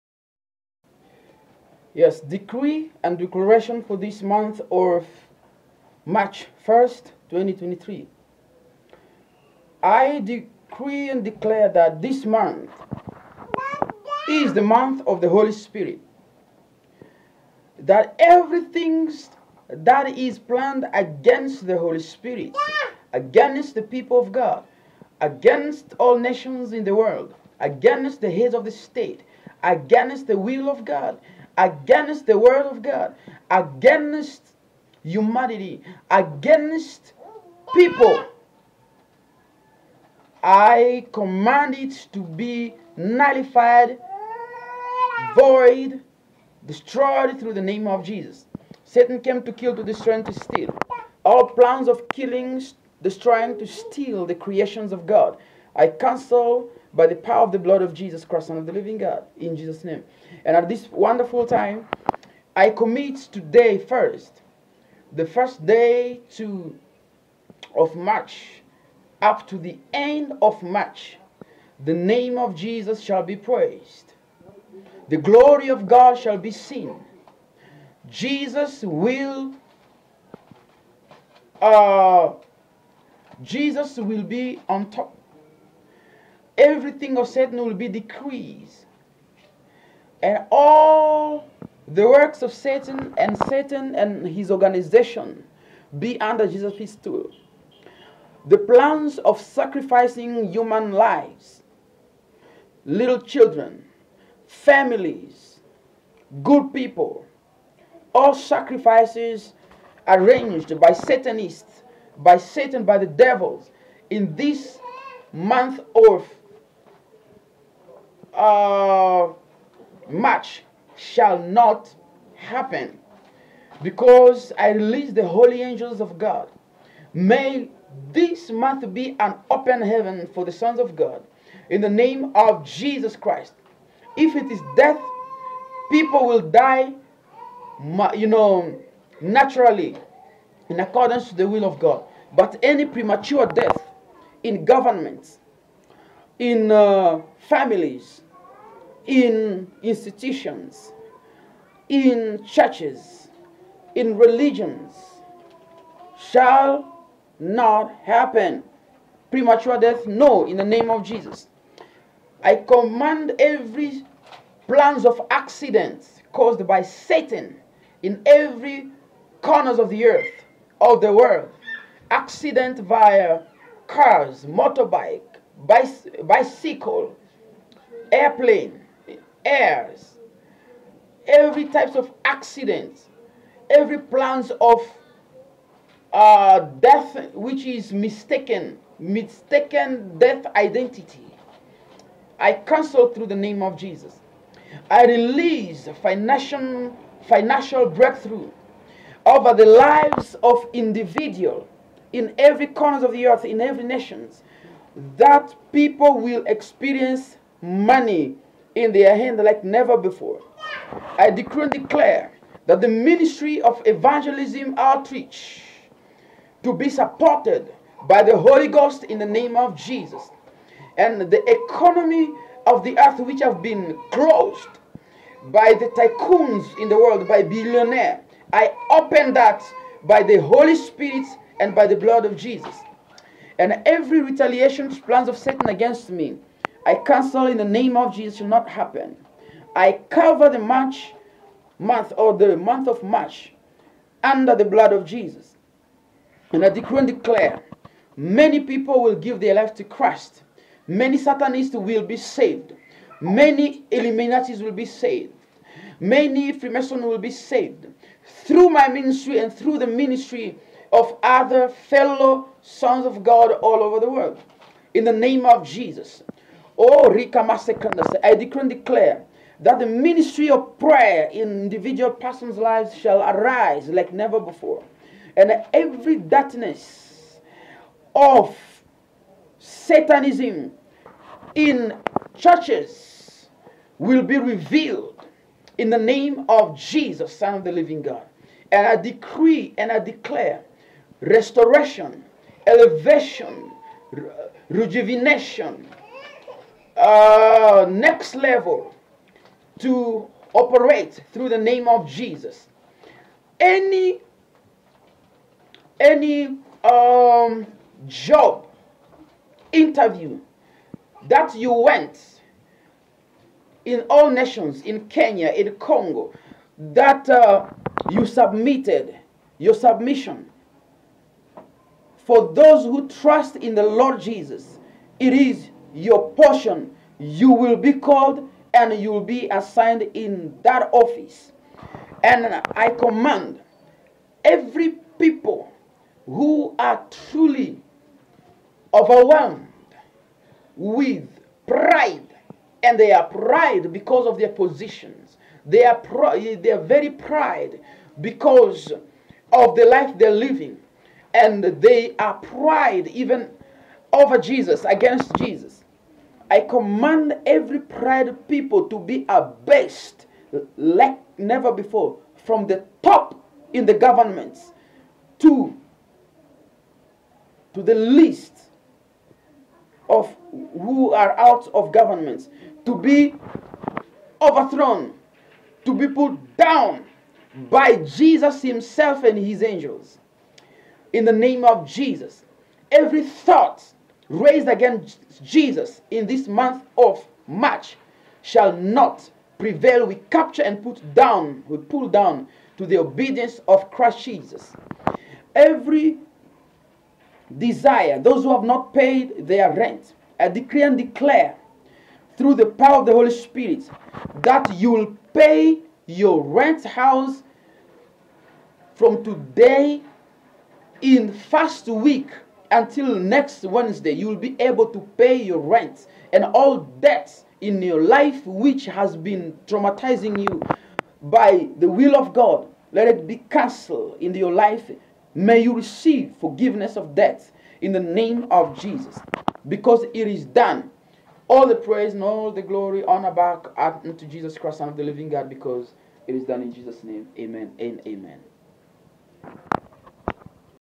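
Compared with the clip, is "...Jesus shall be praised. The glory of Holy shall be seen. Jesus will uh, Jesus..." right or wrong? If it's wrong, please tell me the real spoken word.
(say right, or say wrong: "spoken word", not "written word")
wrong: "God", not "Holy".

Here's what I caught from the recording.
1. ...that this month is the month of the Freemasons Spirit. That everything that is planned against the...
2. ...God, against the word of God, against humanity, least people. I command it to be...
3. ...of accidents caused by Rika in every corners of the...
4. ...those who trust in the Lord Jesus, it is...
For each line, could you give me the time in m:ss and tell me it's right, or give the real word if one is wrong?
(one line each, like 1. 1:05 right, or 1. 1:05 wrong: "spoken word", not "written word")
1. 0:11 wrong: "Holy", not "Freemasons"
2. 0:30 wrong: "against", not "least"
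3. 2:45 wrong: "Satan", not "Rika"
4. 5:22 right.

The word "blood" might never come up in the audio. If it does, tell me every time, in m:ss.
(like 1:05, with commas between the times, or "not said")
0:57, 3:51, 4:04.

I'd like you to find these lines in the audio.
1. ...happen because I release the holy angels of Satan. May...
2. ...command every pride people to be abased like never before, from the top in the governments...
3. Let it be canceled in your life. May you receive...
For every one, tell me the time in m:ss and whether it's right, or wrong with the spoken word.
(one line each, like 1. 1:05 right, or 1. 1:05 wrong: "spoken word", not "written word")
1. 2:02 wrong: "God", not "Satan"
2. 5:56 right
3. 7:02 right.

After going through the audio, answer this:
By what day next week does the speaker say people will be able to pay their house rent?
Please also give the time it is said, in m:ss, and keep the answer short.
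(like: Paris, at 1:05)
Wednesday, at 6:53.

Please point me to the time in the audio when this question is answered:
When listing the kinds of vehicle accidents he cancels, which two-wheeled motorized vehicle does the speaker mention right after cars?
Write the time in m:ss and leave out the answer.
2:54.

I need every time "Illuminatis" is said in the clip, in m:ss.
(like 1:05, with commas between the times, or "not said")
4:13.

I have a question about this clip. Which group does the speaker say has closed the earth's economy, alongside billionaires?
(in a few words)
Tycoons.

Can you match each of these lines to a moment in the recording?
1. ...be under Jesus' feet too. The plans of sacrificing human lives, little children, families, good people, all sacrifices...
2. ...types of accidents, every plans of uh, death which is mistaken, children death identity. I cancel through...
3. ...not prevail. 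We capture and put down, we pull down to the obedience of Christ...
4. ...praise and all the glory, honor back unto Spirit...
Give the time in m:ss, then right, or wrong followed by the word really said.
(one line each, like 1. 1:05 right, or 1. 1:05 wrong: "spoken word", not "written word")
1. 1:35 right
2. 3:01 wrong: "mistaken", not "children"
3. 6:28 right
4. 7:11 wrong: "Jesus", not "Spirit".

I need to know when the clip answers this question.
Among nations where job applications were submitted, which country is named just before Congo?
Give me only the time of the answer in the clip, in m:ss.
5:15.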